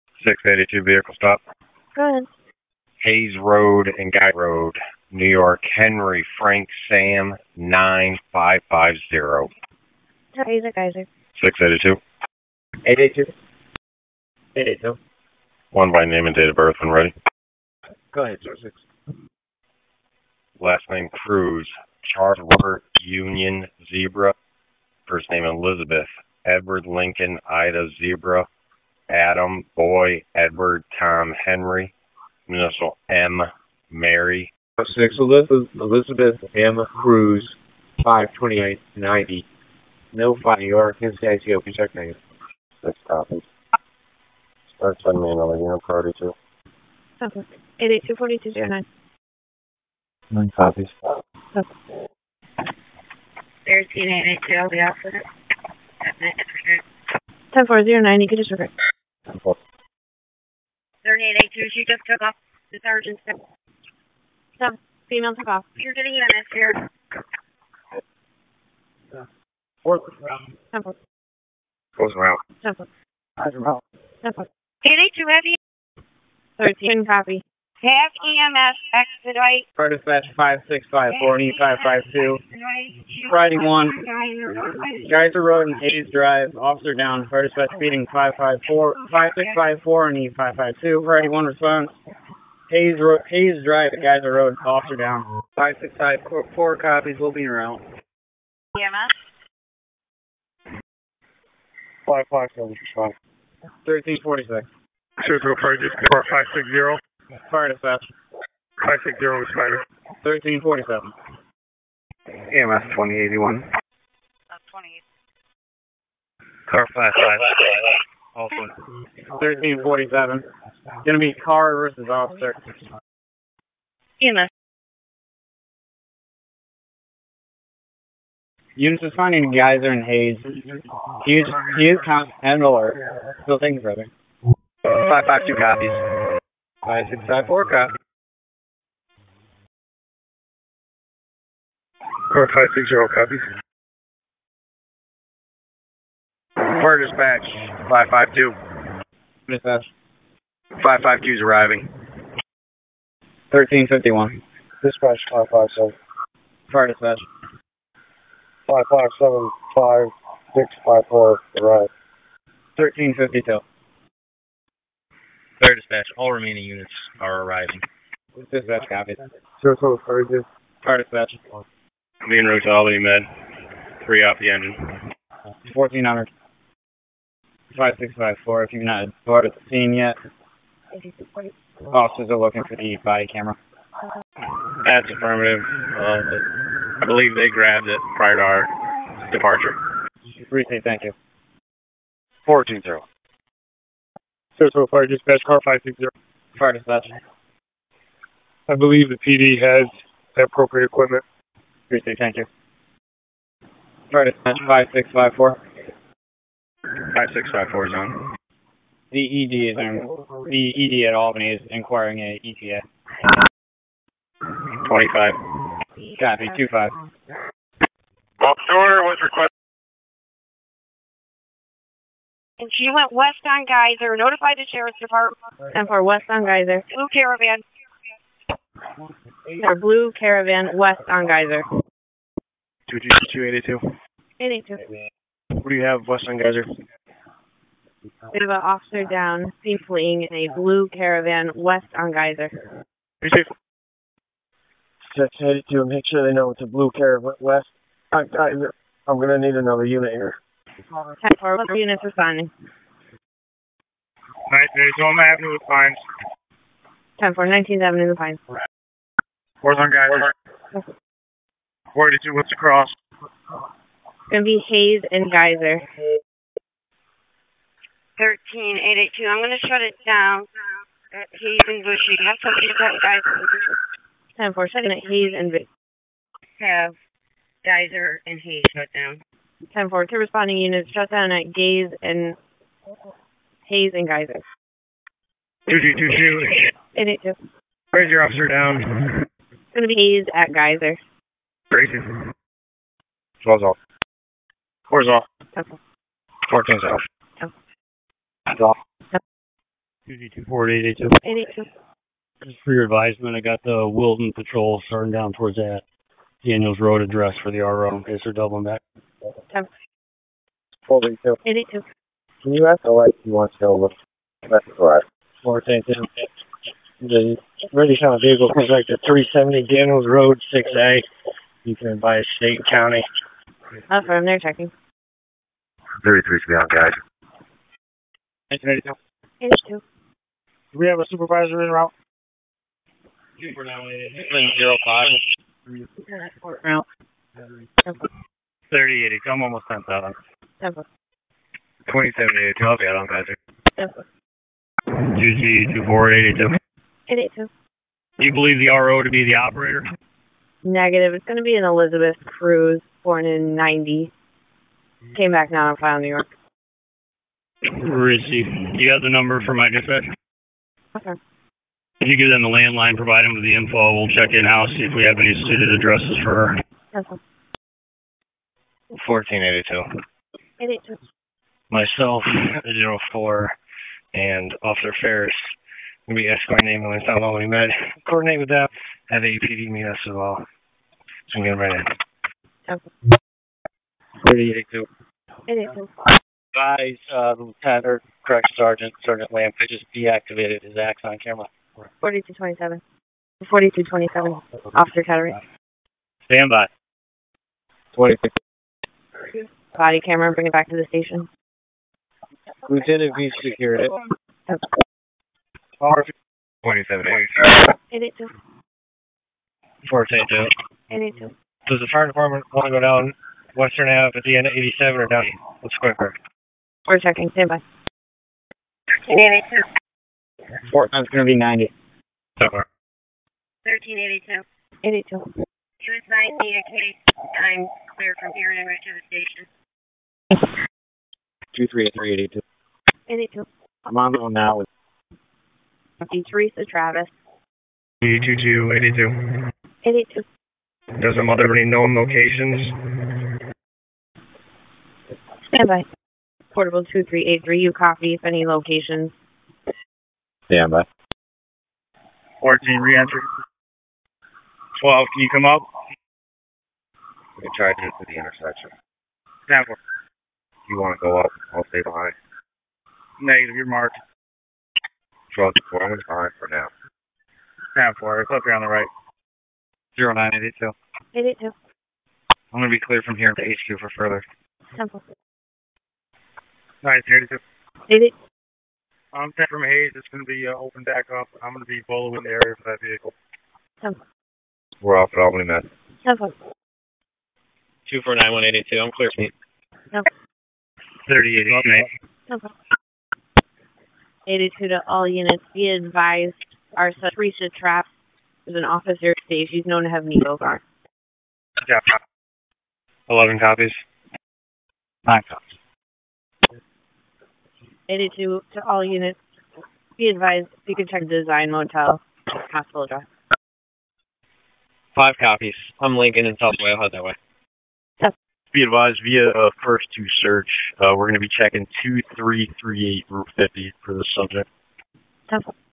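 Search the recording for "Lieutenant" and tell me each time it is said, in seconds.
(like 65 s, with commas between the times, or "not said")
387 s, 402 s.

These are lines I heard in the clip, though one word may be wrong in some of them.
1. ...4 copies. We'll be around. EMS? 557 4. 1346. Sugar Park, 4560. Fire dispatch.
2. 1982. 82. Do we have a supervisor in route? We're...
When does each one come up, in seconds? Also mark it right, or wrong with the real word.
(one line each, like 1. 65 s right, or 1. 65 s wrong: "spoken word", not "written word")
1. 96 s wrong: "5", not "4"
2. 328 s right.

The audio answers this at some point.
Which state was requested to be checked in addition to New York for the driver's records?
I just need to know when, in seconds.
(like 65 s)
41 s.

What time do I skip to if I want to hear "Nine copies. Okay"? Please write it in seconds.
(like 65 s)
50 s.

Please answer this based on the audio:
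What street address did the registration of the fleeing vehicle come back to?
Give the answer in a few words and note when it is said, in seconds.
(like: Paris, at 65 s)
370 Daniels Road, at 319 s.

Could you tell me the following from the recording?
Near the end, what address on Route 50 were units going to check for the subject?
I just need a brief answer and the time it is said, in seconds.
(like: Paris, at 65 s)
2338 Route 50, at 521 s.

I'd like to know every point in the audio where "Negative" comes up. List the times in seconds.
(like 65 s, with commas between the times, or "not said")
350 s, 463 s.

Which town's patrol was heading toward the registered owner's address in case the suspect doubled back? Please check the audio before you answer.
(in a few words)
Wilton.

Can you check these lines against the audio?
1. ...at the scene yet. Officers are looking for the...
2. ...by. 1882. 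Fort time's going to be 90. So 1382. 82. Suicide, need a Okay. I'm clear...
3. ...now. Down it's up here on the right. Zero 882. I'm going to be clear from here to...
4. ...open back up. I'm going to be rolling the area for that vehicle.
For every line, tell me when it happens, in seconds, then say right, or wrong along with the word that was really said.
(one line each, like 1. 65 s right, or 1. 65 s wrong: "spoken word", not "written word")
1. 179 s right
2. 417 s right
3. 466 s right
4. 480 s wrong: "following", not "rolling".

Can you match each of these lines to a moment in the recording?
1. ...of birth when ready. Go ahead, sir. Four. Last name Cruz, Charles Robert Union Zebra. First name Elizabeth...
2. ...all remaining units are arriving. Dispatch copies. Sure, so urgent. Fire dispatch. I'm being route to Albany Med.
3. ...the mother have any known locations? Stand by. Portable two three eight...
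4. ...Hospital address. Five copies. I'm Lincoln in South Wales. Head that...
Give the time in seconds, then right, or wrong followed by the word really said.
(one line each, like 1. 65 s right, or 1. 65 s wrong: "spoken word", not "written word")
1. 16 s wrong: "Six", not "Four"
2. 166 s right
3. 441 s right
4. 512 s right.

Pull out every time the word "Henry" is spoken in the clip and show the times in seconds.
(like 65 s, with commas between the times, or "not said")
5 s, 31 s.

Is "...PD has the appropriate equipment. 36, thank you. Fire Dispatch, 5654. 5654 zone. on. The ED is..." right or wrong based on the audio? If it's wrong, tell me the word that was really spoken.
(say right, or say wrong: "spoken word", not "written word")
right.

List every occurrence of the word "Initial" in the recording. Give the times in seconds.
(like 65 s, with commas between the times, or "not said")
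32 s.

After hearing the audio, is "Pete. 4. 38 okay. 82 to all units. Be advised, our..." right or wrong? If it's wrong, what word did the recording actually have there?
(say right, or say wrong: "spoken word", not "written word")
right.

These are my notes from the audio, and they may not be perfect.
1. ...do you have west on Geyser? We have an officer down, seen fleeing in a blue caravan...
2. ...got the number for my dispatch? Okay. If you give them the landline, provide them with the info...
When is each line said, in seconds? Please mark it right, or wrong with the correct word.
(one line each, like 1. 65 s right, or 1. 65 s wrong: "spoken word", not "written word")
1. 235 s right
2. 358 s right.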